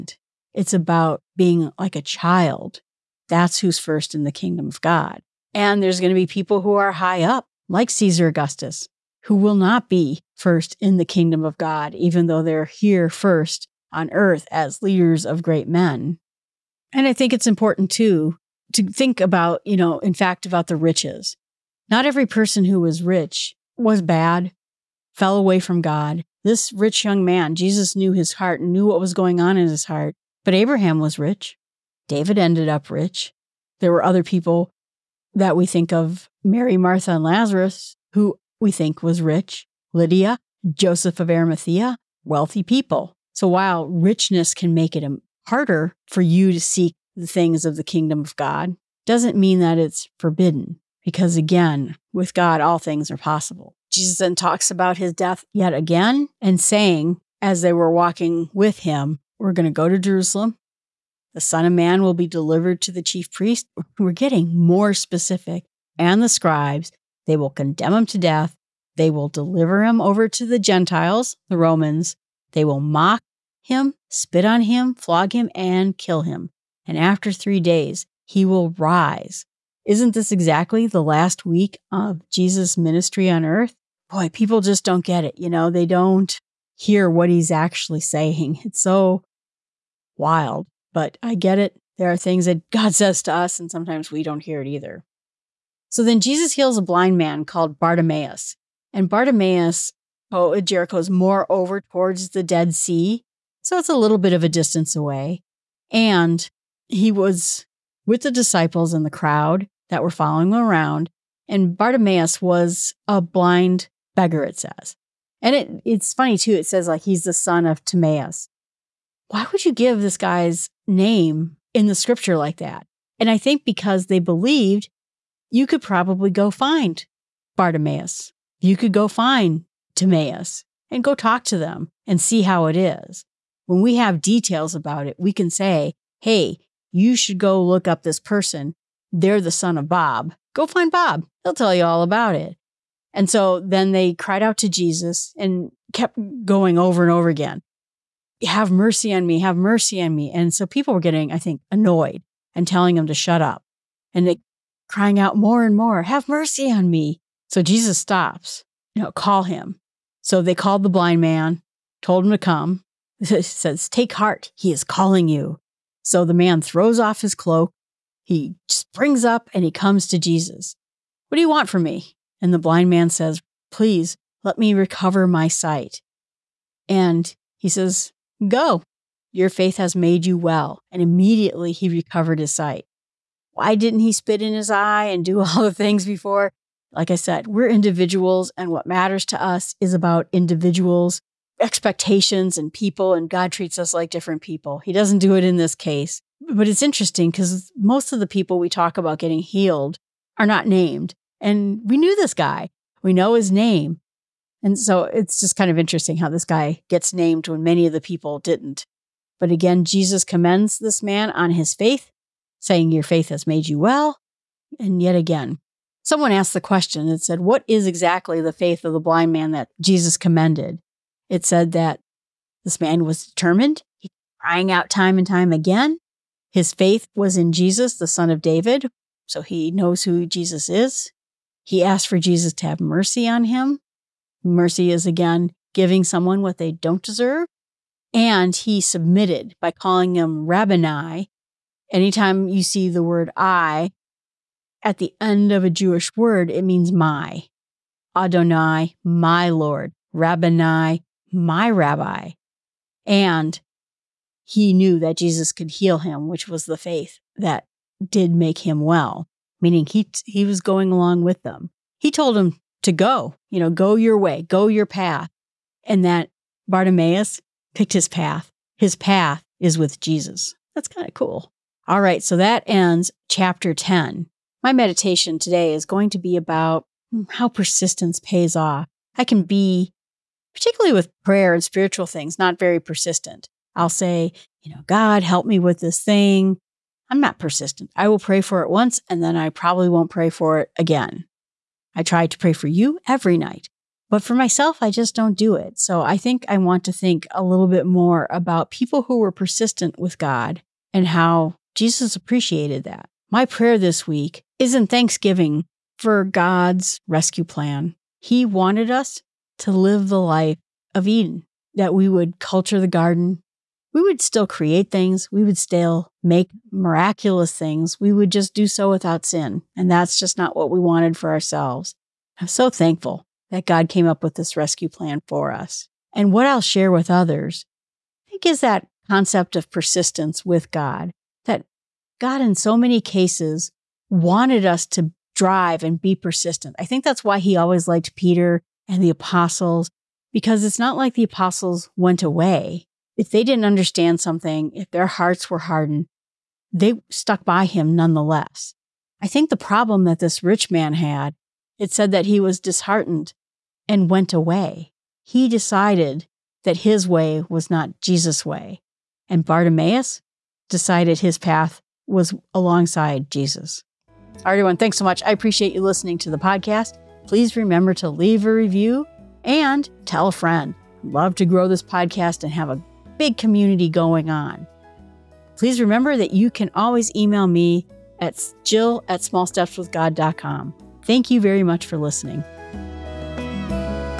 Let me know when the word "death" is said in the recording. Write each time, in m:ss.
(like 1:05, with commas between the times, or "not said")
0:55, 1:08.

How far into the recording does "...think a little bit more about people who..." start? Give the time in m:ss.
4:56.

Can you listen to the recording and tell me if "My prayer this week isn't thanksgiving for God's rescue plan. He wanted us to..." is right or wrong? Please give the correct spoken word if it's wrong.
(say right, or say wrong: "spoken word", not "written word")
right.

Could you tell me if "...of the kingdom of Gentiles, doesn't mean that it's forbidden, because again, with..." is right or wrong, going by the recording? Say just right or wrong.
wrong.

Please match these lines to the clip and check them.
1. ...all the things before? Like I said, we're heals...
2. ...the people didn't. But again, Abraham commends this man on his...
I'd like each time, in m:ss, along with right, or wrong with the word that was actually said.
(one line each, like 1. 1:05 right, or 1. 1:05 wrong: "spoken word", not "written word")
1. 3:05 wrong: "individuals", not "heals"
2. 3:27 wrong: "Jesus", not "Abraham".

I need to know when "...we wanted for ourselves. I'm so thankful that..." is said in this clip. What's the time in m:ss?
5:20.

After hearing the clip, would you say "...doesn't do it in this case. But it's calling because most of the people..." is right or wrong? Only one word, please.
wrong.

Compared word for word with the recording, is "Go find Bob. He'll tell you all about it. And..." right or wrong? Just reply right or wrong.
right.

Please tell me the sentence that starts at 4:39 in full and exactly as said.
I can be, particularly with prayer and spiritual things, not very persistent.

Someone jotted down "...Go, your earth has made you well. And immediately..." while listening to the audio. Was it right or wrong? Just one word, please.
wrong.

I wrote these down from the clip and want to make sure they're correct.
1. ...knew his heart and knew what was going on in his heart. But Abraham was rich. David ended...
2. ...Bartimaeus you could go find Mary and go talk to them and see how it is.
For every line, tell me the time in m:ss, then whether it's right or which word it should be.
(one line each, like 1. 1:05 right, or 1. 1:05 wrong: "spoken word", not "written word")
1. 0:27 right
2. 2:07 wrong: "Timaeus", not "Mary".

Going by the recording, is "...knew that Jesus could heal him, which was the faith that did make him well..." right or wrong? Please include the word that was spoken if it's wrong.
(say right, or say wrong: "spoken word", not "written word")
right.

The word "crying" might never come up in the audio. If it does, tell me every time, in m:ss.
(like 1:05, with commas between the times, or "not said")
2:34, 3:44.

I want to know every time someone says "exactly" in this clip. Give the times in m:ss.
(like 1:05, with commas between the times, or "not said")
1:20, 3:37.